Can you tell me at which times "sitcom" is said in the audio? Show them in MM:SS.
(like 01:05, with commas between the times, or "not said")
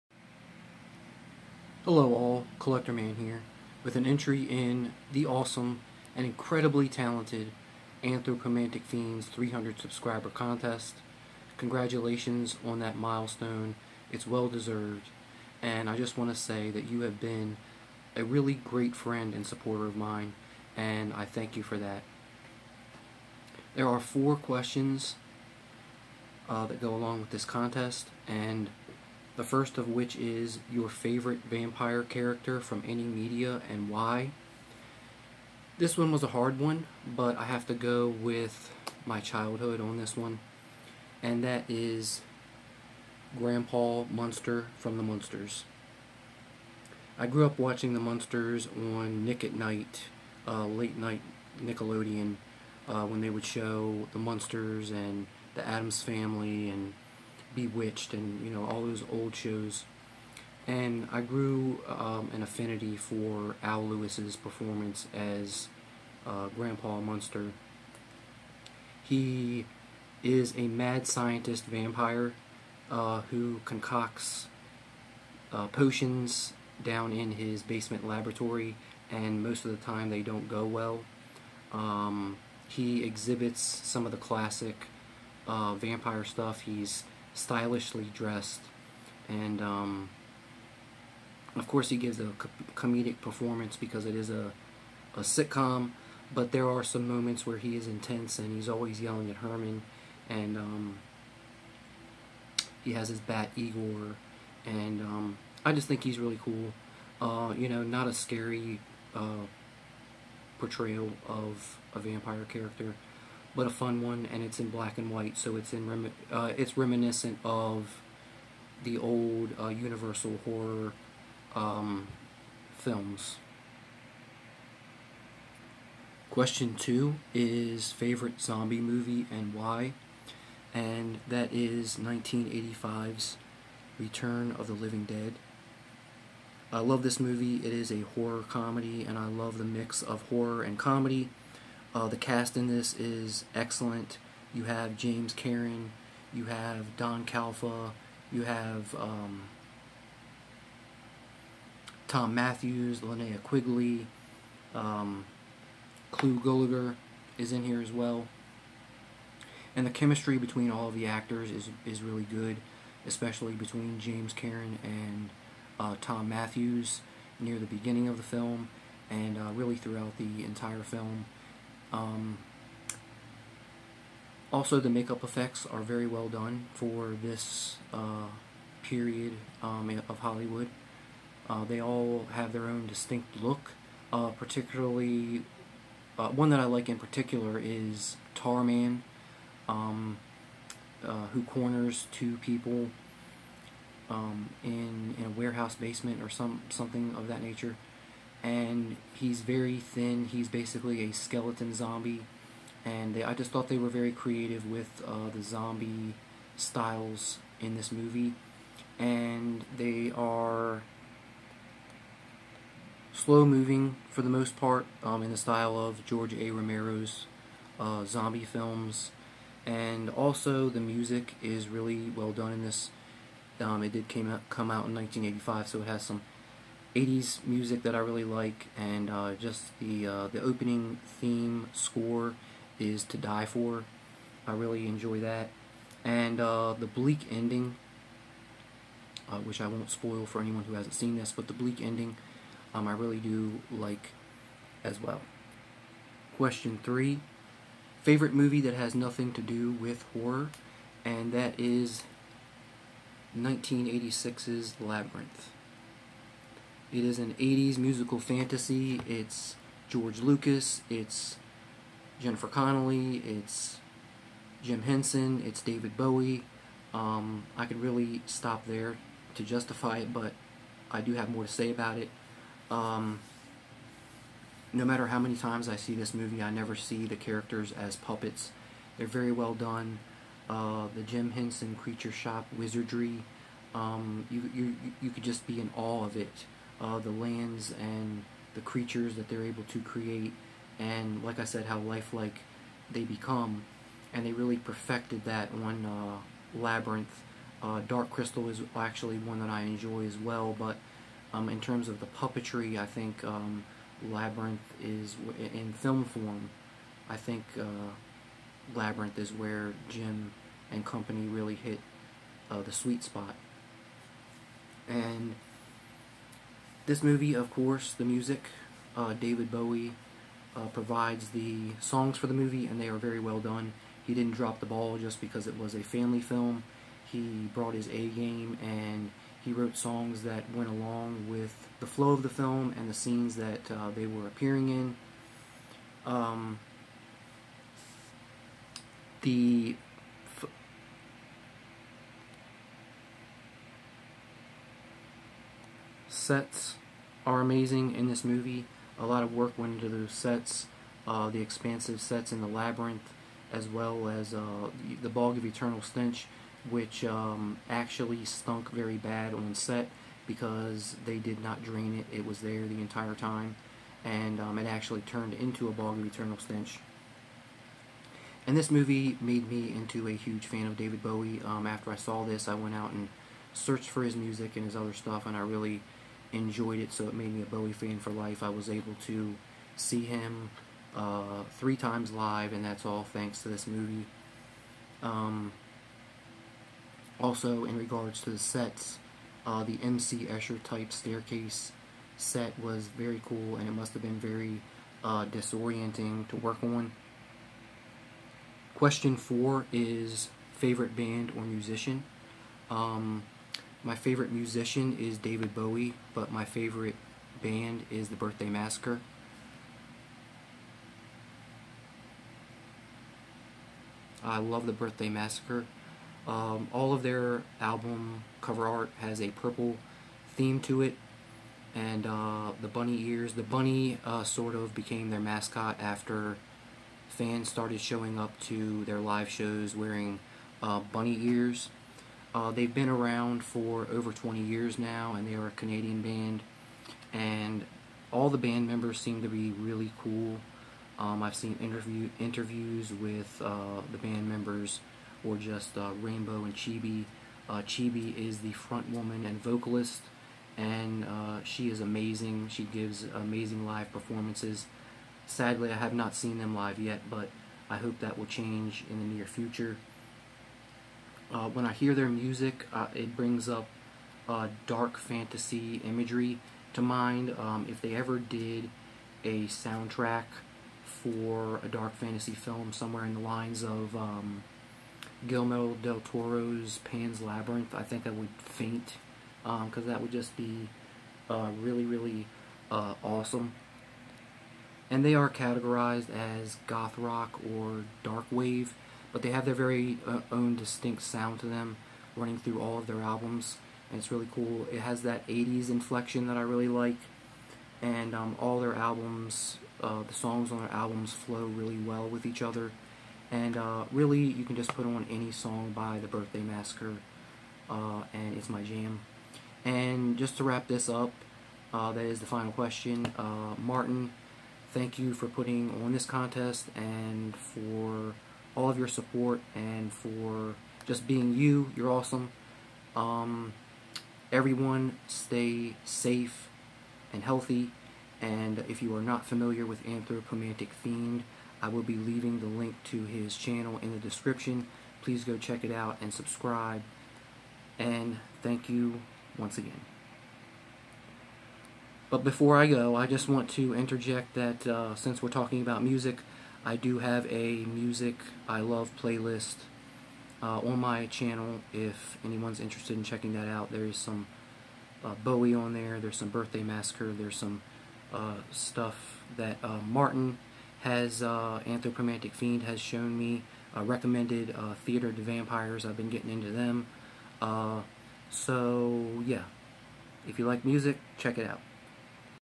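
01:35.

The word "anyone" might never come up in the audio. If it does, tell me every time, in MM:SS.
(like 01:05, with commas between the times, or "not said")
04:00, 09:12.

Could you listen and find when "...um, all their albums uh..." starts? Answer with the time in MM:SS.
08:18.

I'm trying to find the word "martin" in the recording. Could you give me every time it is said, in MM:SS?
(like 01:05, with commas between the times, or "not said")
08:33, 09:19.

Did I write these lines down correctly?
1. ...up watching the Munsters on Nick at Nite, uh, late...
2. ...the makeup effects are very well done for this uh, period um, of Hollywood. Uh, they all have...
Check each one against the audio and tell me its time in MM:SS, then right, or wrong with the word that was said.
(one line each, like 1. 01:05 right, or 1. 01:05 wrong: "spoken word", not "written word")
1. 00:47 right
2. 02:54 right.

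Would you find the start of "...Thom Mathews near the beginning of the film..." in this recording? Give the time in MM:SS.
02:45.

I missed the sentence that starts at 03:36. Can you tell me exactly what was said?
Romero's uh, zombie films, and also the music is really well done in this.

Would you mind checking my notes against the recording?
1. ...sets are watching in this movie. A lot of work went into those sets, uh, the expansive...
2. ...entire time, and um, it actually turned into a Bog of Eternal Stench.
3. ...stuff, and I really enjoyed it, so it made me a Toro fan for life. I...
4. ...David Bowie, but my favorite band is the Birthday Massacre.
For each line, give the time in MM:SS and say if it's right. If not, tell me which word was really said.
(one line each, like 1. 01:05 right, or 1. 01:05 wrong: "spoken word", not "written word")
1. 05:46 wrong: "amazing", not "watching"
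2. 06:02 right
3. 06:14 wrong: "Bowie", not "Toro"
4. 06:45 right.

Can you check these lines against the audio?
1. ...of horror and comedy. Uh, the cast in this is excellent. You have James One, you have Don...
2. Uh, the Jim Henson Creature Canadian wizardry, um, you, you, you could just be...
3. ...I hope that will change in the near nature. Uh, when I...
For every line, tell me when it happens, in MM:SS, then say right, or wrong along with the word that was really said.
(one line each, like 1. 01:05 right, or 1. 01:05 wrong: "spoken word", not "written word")
1. 02:20 wrong: "Karen", not "One"
2. 04:40 wrong: "Shop", not "Canadian"
3. 07:37 wrong: "future", not "nature".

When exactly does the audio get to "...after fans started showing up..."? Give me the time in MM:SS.
07:05.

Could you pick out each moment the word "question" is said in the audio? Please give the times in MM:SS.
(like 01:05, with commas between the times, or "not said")
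00:24, 02:06, 04:06, 06:38, 08:32.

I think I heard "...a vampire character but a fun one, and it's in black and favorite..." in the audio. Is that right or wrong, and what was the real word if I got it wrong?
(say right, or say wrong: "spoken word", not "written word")
wrong: "white", not "favorite".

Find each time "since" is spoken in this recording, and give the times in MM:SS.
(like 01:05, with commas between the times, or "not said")
09:04.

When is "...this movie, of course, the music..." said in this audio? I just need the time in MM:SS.
05:16.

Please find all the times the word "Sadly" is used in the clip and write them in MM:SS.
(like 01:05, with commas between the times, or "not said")
07:35.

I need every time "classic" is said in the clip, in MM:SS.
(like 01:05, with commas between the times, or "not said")
01:24.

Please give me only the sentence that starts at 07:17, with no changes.
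And all the band members seem to be really cool.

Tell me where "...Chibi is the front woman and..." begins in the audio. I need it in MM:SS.
07:27.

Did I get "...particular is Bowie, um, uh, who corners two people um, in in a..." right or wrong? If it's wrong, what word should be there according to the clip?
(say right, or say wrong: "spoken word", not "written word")
wrong: "Tarman", not "Bowie".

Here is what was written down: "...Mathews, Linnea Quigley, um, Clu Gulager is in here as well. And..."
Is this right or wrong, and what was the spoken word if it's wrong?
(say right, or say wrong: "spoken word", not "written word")
right.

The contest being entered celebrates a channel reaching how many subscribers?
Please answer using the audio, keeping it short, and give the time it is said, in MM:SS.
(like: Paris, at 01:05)
300, at 00:09.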